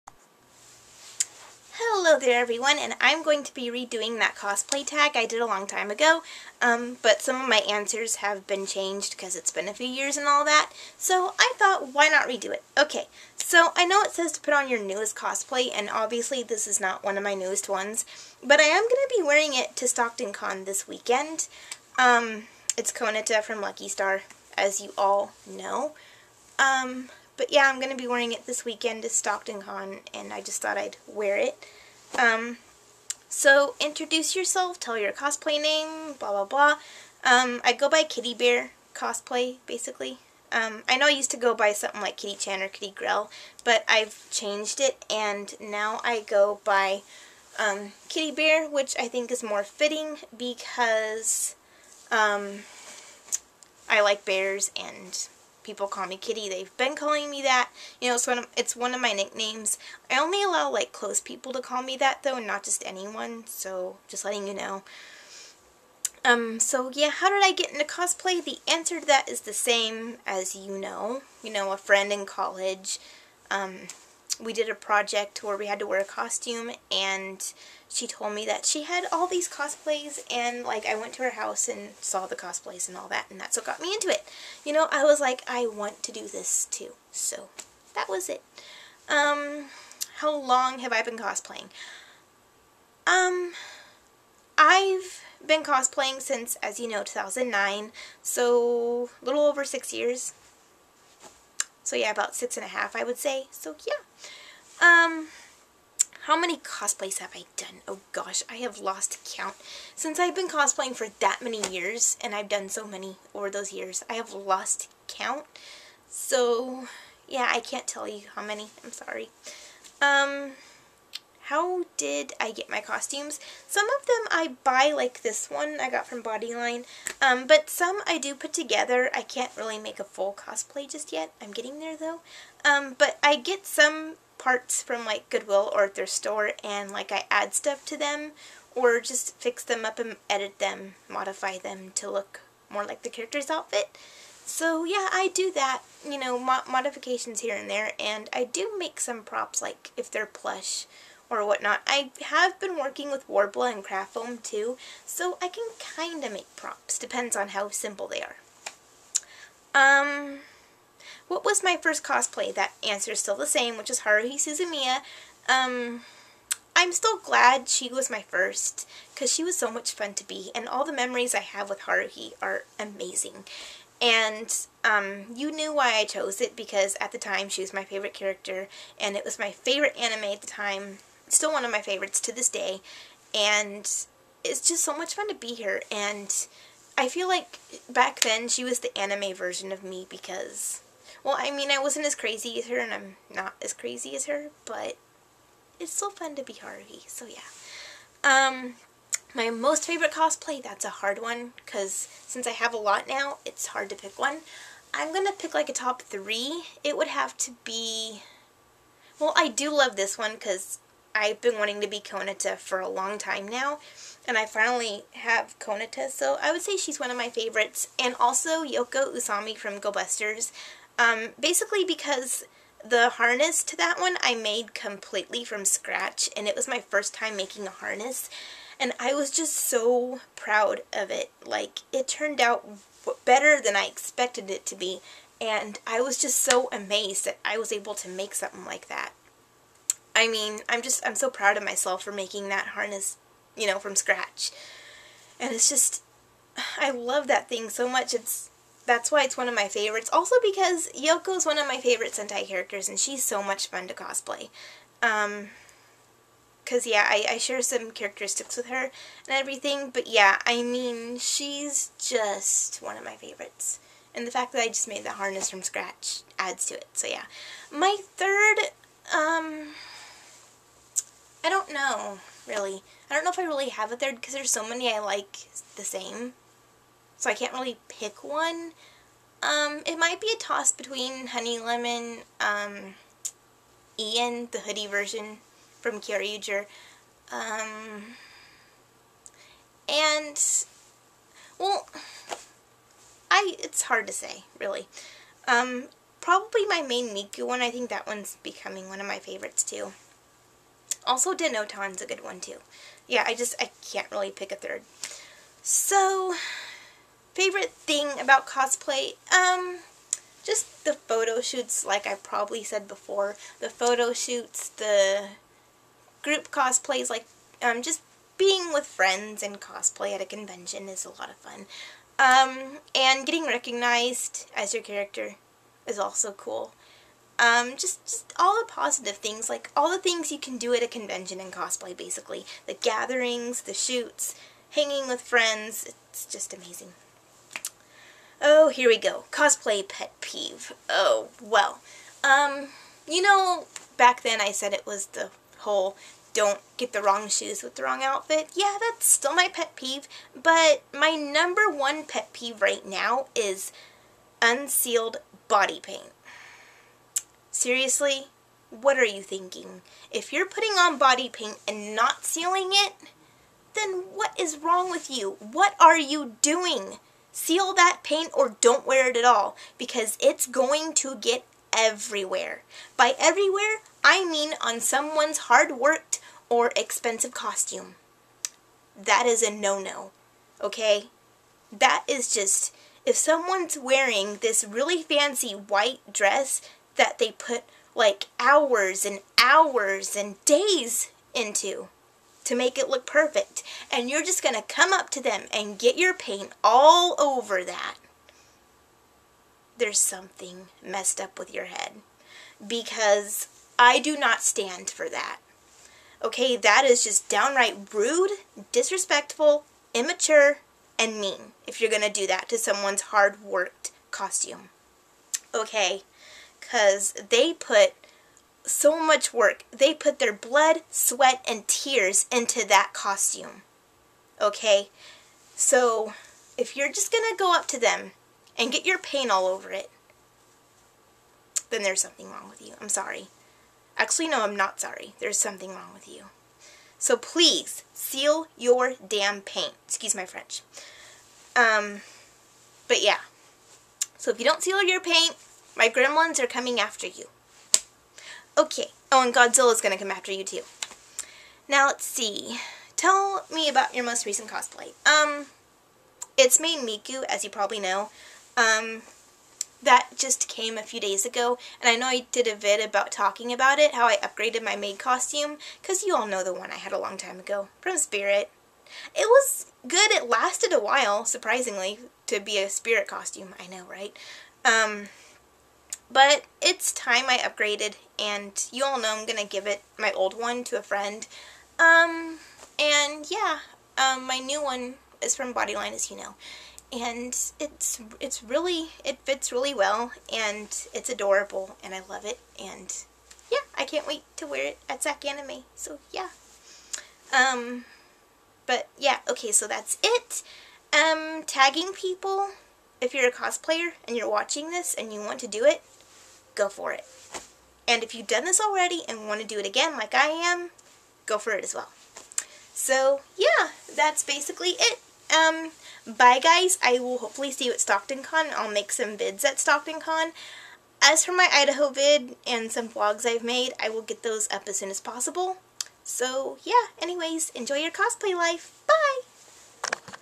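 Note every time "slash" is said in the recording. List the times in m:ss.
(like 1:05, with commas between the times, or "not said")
not said.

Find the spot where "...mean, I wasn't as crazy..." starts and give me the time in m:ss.
3:11.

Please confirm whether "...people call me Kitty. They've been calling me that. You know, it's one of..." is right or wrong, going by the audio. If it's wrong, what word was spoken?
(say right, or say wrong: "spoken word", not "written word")
right.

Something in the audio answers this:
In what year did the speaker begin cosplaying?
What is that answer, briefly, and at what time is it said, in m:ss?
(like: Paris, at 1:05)
2009, at 1:37.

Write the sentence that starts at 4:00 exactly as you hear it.
I mean, I'm just, I'm so proud of myself for making that harness, you know, from scratch.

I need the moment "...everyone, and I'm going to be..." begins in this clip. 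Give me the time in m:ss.
0:02.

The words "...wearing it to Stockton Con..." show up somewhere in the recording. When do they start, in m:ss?
0:19.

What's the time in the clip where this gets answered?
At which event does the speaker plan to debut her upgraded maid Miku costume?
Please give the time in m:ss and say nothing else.
8:15.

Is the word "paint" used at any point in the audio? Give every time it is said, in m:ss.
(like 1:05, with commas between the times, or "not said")
5:55, 6:01, 6:08, 6:36, 7:08, 7:19, 7:25.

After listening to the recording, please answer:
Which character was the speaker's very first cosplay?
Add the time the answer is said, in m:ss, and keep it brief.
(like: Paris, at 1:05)
Haruhi Suzumiya, at 2:44.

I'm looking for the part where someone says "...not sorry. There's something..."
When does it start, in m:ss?
7:14.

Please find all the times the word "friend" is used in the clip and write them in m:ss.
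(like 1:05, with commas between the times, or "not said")
1:11, 5:18, 5:35, 8:00.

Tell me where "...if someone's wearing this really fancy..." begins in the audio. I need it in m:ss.
6:23.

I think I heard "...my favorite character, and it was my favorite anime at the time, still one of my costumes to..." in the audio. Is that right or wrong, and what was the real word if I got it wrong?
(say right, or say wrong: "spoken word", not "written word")
wrong: "favorites", not "costumes".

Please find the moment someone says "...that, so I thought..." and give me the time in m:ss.
0:10.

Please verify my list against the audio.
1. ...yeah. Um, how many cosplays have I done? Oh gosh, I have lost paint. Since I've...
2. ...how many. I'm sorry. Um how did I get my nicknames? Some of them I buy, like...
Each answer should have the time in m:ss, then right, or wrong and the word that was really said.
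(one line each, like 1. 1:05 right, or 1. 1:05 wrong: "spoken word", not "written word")
1. 1:43 wrong: "count", not "paint"
2. 1:58 wrong: "costumes", not "nicknames".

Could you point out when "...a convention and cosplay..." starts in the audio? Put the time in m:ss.
5:30.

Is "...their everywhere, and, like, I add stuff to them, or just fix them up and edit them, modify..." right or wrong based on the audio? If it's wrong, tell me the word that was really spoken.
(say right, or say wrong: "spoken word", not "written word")
wrong: "store", not "everywhere".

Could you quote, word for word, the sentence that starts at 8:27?
And if you've done this already and want to do it again like I am, go for it as well.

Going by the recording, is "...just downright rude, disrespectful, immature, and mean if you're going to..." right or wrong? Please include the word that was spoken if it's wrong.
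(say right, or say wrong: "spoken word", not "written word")
right.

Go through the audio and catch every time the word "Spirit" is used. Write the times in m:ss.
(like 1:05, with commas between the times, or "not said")
7:47, 7:52.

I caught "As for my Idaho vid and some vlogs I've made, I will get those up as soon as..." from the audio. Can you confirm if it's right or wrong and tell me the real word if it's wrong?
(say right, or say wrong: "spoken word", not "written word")
right.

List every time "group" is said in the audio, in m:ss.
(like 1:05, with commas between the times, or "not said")
5:16.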